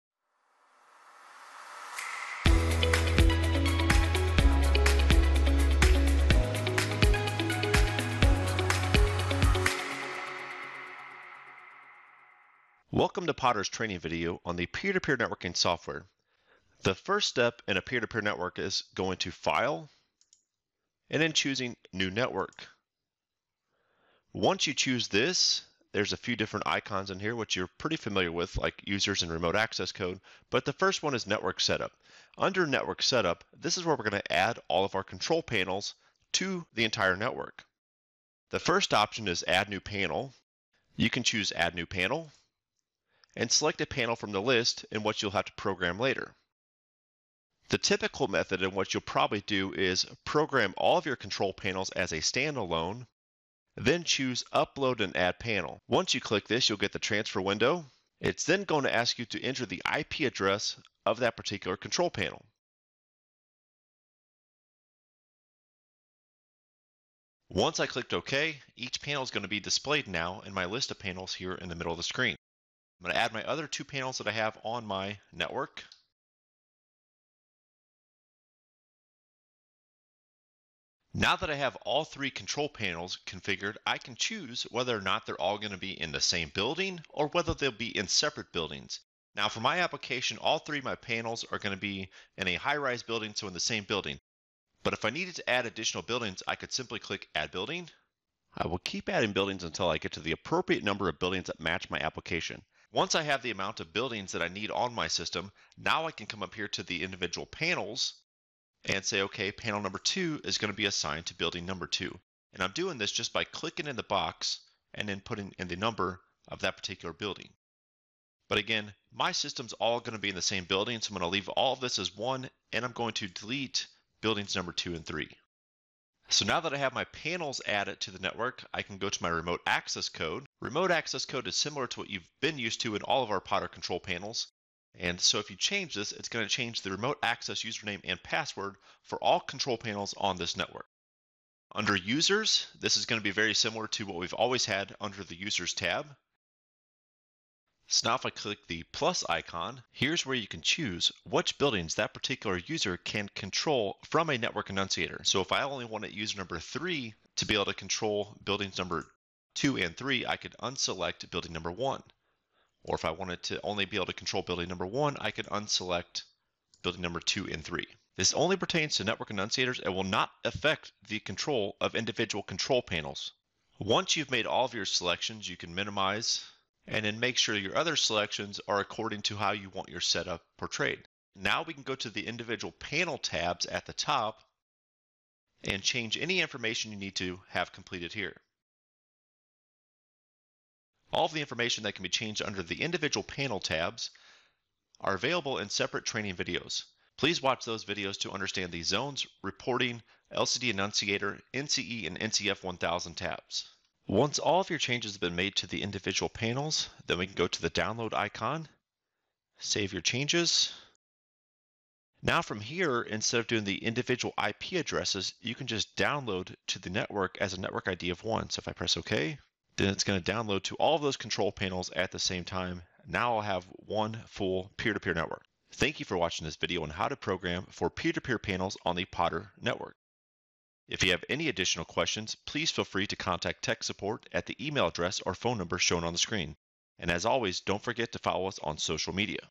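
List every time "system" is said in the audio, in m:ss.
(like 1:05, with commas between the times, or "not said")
1:45, 1:59.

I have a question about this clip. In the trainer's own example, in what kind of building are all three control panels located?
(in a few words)
high-rise building.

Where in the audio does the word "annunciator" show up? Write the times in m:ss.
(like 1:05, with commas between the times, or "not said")
2:34, 2:49, 3:20.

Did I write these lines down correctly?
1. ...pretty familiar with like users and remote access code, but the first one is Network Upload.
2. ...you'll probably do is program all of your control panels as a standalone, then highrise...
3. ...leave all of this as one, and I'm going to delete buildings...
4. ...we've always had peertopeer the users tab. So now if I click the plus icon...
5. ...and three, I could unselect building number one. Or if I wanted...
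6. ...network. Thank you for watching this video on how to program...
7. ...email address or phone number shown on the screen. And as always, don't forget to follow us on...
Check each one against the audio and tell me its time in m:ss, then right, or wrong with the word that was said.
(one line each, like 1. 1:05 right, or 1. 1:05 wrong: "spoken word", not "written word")
1. 0:27 wrong: "Setup", not "Upload"
2. 0:48 wrong: "choose", not "highrise"
3. 2:01 right
4. 2:24 wrong: "under", not "peertopeer"
5. 2:39 right
6. 3:45 right
7. 3:54 right.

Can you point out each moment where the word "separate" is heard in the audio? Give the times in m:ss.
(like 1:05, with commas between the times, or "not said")
1:28, 3:15.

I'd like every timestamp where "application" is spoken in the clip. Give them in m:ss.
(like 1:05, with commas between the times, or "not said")
1:29, 1:41.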